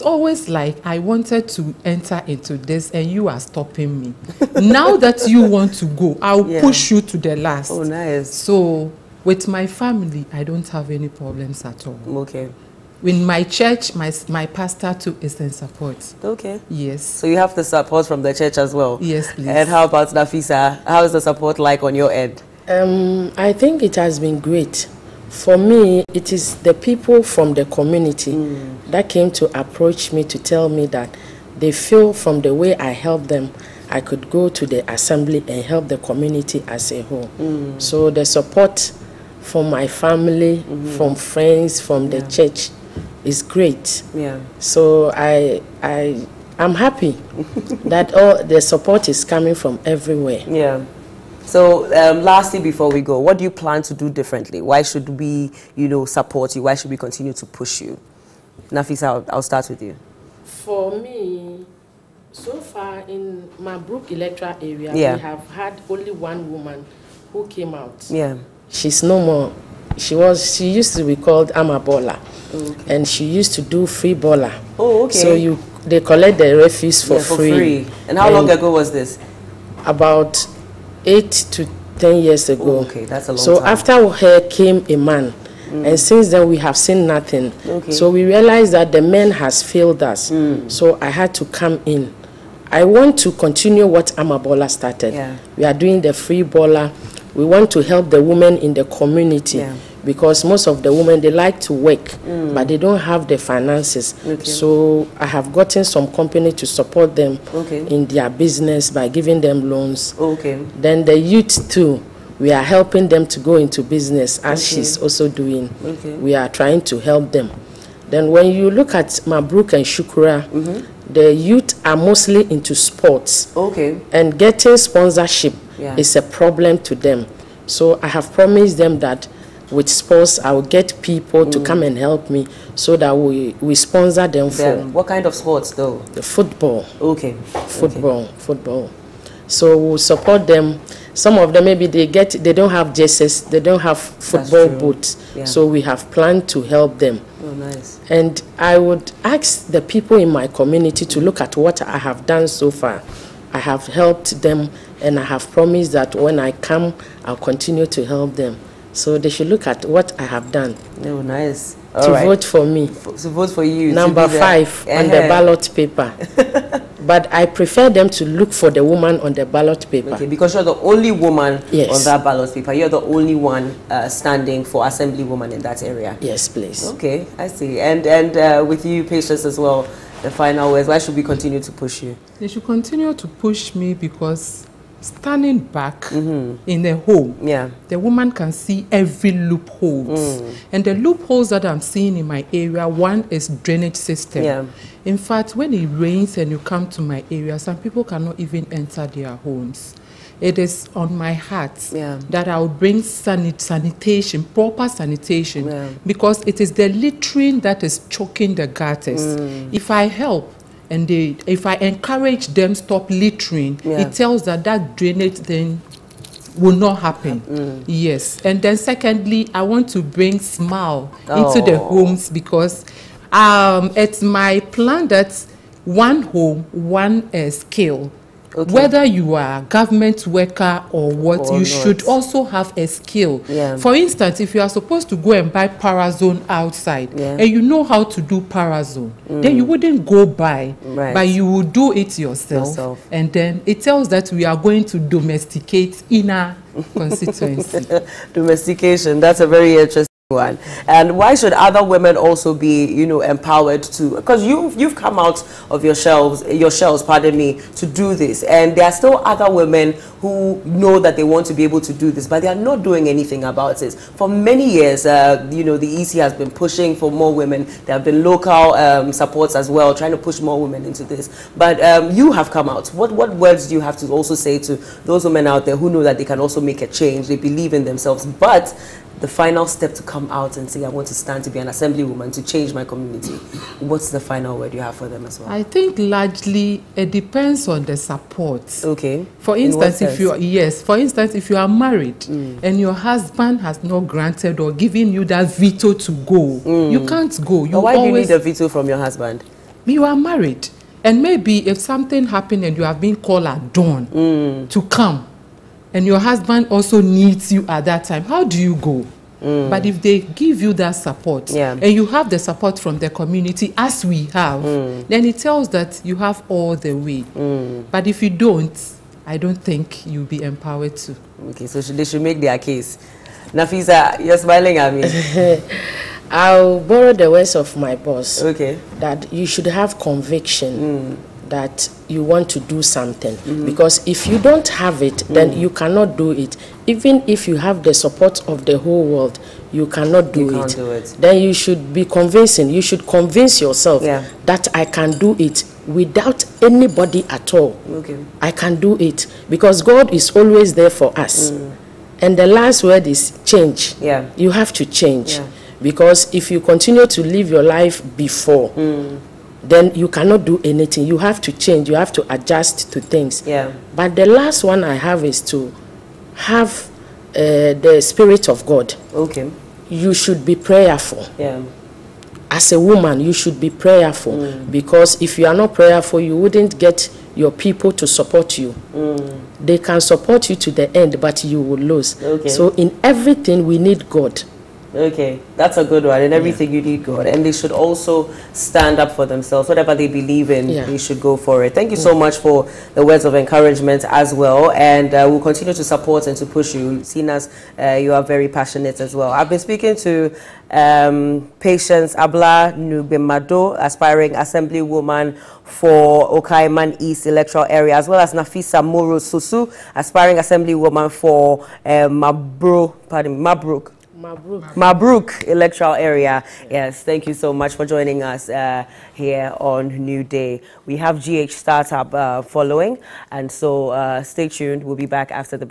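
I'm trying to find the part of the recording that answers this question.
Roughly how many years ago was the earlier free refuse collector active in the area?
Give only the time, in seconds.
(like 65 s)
81 s.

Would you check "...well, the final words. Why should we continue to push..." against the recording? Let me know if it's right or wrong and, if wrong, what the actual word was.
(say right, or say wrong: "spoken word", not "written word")
right.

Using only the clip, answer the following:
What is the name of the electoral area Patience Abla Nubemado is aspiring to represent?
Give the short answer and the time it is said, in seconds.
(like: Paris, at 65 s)
Okaiman East, at 406 s.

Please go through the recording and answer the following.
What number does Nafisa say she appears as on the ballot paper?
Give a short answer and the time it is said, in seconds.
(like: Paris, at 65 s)
5, at 163 s.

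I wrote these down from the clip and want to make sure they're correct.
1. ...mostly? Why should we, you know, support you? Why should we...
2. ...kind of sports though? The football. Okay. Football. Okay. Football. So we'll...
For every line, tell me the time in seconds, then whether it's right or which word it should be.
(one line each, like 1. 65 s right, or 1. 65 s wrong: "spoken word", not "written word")
1. 54 s wrong: "differently", not "mostly"
2. 135 s right.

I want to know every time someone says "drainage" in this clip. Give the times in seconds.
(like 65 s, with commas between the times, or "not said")
193 s, 214 s.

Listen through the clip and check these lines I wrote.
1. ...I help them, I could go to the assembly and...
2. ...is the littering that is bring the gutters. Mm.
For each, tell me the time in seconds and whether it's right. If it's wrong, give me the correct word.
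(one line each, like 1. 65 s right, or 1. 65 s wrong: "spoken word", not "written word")
1. 32 s right
2. 206 s wrong: "choking", not "bring".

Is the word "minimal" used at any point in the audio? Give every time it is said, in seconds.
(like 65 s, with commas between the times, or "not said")
not said.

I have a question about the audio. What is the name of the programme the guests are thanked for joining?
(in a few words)
New Day.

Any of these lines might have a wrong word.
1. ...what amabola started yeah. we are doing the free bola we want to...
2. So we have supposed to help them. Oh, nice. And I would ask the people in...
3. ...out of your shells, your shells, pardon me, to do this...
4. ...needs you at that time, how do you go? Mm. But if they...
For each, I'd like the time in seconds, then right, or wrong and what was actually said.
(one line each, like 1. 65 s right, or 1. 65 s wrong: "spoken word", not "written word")
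1. 93 s right
2. 145 s wrong: "planned", not "supposed"
3. 255 s right
4. 307 s right.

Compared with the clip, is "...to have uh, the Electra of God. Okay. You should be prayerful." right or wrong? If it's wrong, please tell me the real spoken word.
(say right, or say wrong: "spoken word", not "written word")
wrong: "Spirit", not "Electra".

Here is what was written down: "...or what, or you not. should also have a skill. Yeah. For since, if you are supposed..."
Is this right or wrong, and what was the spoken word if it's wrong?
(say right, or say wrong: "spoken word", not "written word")
wrong: "instance", not "since".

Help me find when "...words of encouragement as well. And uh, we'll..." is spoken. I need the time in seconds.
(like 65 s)
393 s.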